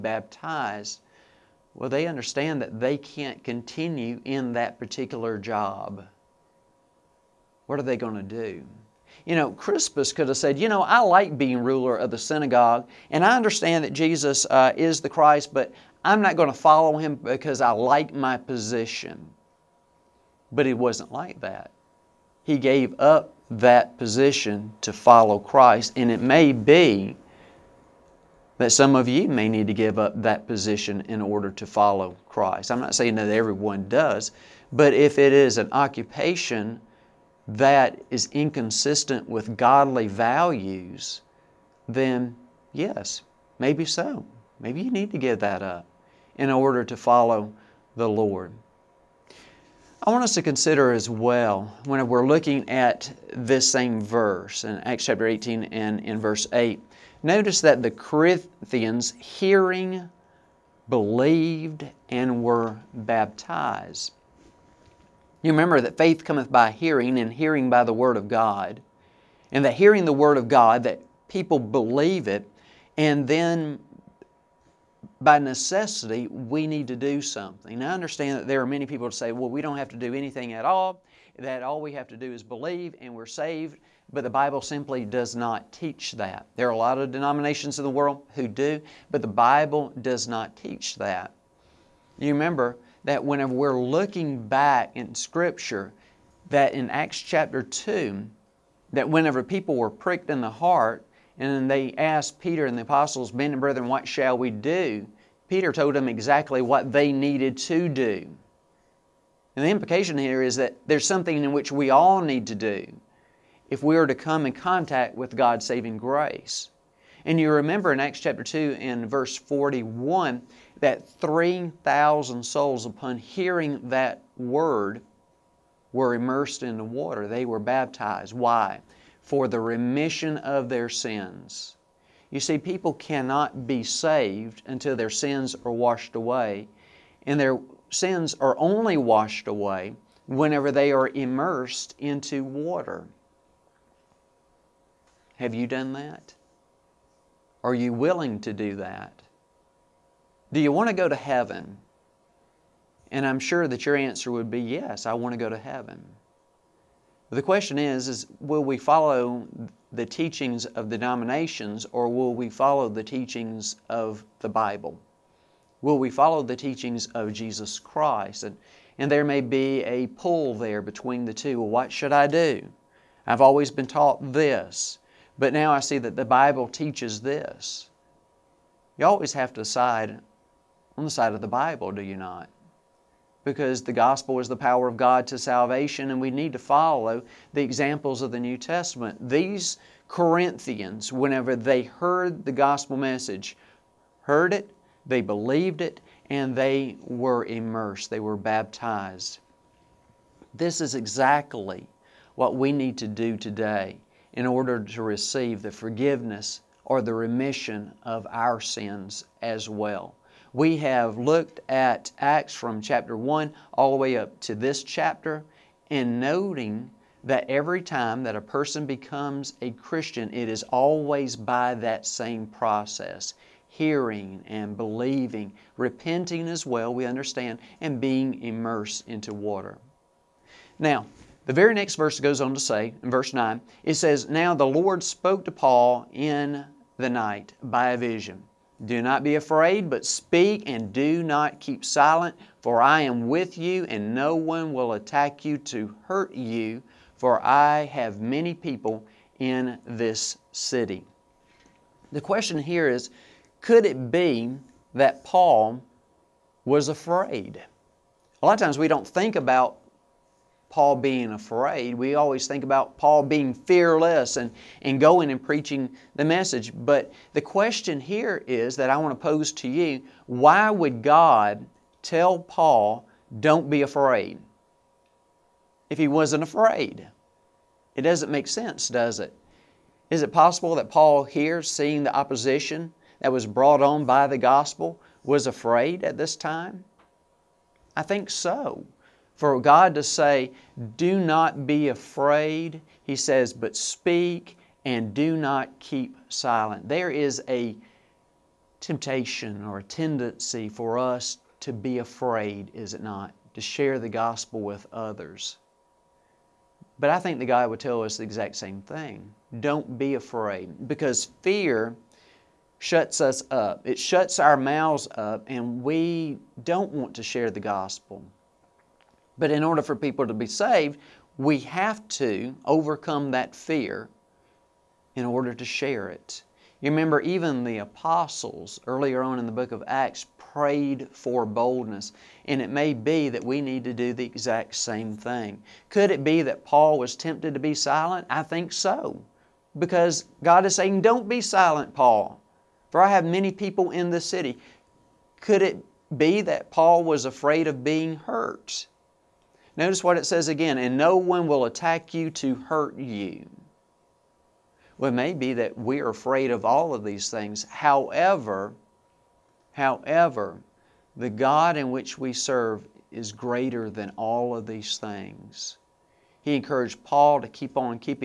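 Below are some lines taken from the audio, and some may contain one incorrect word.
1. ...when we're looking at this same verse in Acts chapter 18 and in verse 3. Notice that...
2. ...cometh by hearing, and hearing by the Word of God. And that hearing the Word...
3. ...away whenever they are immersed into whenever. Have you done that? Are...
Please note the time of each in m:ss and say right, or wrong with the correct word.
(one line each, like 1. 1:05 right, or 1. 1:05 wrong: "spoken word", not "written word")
1. 0:51 wrong: "8", not "3"
2. 1:06 right
3. 2:19 wrong: "water", not "whenever".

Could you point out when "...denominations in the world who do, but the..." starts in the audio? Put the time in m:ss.
1:27.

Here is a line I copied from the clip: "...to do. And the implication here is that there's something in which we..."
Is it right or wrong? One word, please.
right.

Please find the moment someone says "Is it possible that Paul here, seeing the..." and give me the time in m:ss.
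4:40.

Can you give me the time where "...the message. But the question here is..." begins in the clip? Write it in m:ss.
4:26.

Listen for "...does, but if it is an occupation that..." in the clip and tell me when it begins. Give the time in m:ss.
0:33.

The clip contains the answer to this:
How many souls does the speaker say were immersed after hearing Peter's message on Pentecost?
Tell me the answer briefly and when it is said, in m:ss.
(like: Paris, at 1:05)
3,000, at 2:01.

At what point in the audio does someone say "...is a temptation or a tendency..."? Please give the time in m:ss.
4:57.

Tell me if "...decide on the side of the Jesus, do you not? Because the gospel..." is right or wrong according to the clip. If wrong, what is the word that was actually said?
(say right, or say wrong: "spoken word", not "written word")
wrong: "Bible", not "Jesus".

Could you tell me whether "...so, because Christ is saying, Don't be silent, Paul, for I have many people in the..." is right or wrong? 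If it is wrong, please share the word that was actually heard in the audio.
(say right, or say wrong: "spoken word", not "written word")
wrong: "God", not "Christ".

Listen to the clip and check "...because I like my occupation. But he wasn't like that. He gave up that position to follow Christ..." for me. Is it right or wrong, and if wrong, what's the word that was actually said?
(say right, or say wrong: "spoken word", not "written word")
wrong: "position", not "occupation".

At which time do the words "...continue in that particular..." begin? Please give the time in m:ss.
0:03.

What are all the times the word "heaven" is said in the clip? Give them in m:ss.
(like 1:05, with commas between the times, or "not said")
2:31, 2:35.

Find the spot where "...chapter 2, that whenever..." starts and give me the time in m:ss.
1:37.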